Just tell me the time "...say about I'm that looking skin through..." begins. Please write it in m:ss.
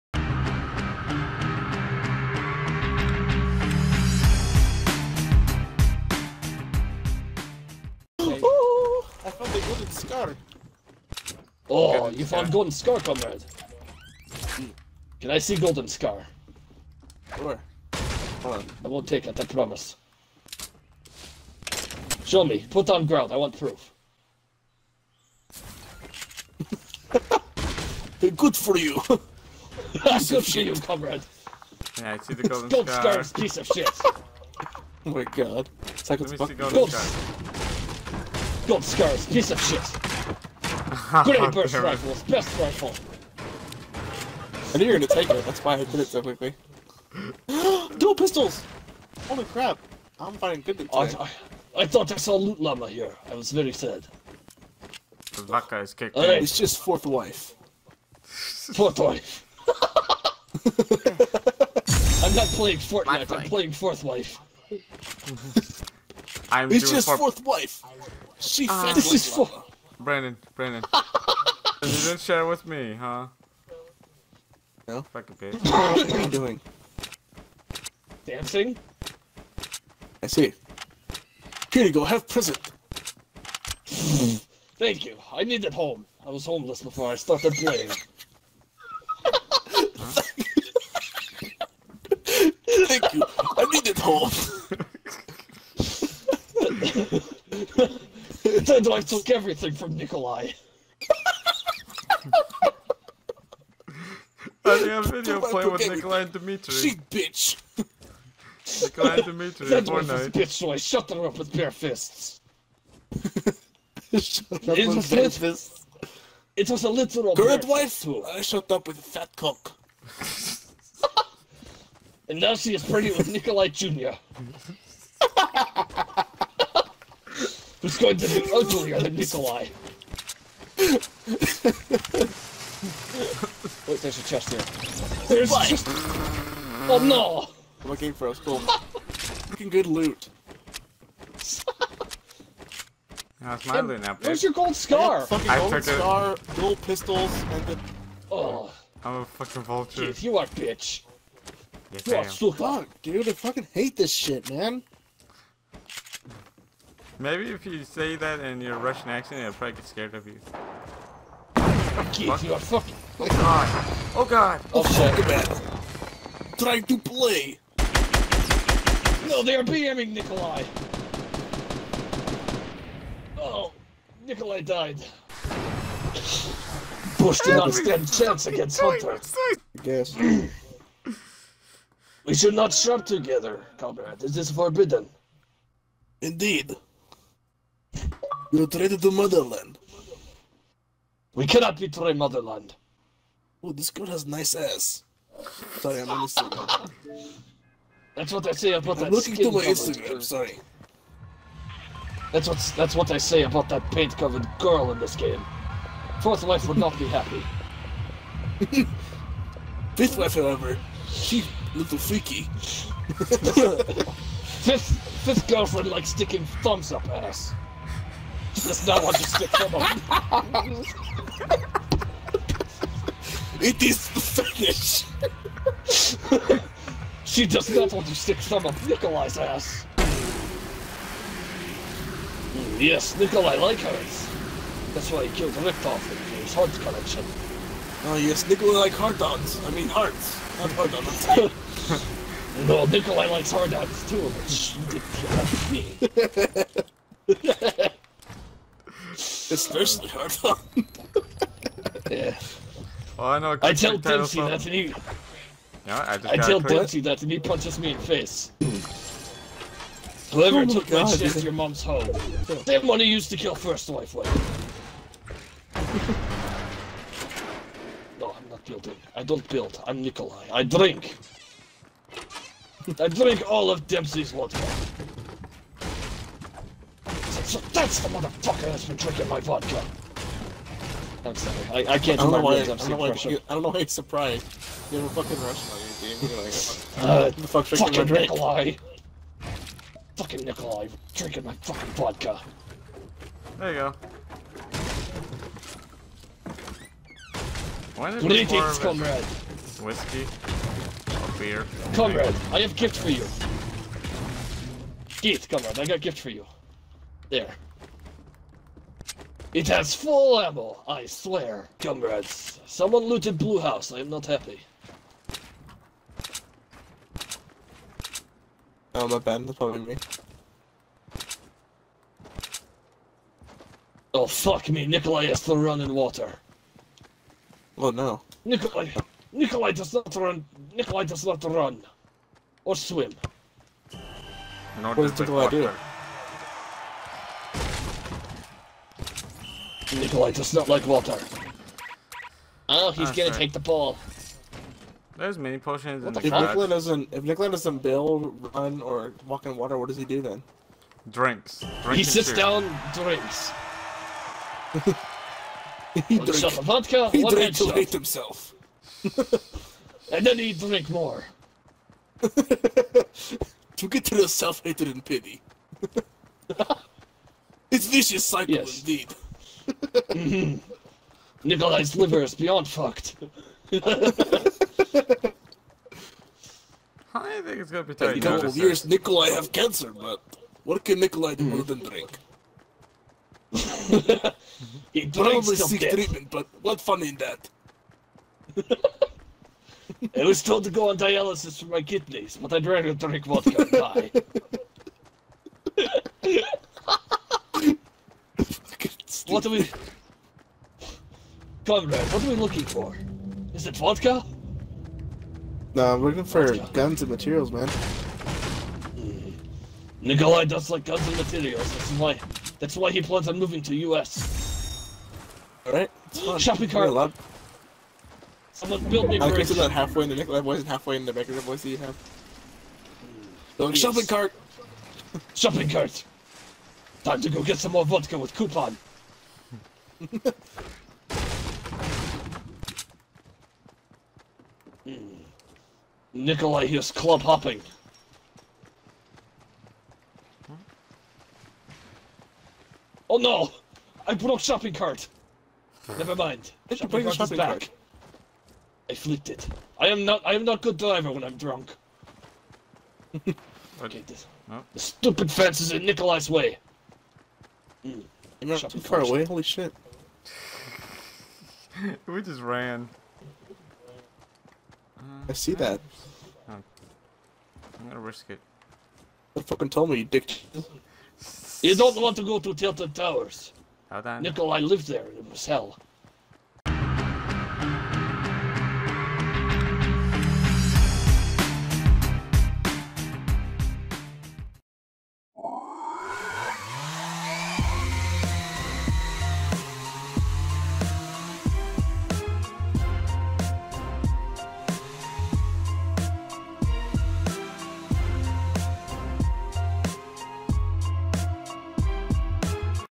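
3:18.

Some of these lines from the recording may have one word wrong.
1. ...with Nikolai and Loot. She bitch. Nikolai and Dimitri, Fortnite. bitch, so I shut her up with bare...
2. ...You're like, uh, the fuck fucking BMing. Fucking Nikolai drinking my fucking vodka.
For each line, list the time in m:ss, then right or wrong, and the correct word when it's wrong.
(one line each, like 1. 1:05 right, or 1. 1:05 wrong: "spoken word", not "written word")
1. 1:45 wrong: "Dimitri", not "Loot"
2. 4:46 wrong: "Nikolai", not "BMing".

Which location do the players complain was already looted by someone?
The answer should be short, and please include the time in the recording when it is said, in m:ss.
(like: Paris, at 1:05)
Blue House, at 5:13.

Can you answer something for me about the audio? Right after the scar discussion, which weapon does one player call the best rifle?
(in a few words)
Grenade burst rifle.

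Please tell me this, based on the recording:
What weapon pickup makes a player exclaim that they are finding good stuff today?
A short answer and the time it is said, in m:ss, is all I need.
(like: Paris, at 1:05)
Dual pistols, at 0:47.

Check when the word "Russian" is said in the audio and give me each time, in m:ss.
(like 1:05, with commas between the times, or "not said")
2:38, 4:45.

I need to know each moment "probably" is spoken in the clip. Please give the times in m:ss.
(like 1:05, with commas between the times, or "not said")
2:39, 5:19, 6:25.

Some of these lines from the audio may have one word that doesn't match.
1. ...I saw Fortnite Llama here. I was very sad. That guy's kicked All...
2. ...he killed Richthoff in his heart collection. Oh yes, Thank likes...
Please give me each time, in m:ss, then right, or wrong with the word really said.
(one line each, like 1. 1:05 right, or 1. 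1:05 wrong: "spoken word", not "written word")
1. 0:52 wrong: "Loot", not "Fortnite"
2. 3:55 wrong: "Nikolai", not "Thank".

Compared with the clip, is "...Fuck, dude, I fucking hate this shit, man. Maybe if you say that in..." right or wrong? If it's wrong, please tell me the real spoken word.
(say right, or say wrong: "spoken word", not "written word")
right.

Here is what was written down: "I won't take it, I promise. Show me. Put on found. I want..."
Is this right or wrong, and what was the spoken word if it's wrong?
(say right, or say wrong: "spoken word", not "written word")
wrong: "ground", not "found".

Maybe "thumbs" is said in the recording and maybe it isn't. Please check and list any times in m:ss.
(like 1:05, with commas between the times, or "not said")
3:36, 3:48.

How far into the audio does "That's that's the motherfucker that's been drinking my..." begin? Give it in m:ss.
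4:37.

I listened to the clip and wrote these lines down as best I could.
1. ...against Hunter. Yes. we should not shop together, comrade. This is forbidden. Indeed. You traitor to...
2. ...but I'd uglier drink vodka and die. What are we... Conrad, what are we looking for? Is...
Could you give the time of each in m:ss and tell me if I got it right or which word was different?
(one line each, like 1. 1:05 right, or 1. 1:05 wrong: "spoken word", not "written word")
1. 2:58 right
2. 6:32 wrong: "rather", not "uglier".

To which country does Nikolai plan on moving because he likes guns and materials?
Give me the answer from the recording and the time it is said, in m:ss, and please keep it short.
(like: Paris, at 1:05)
U.S., at 6:53.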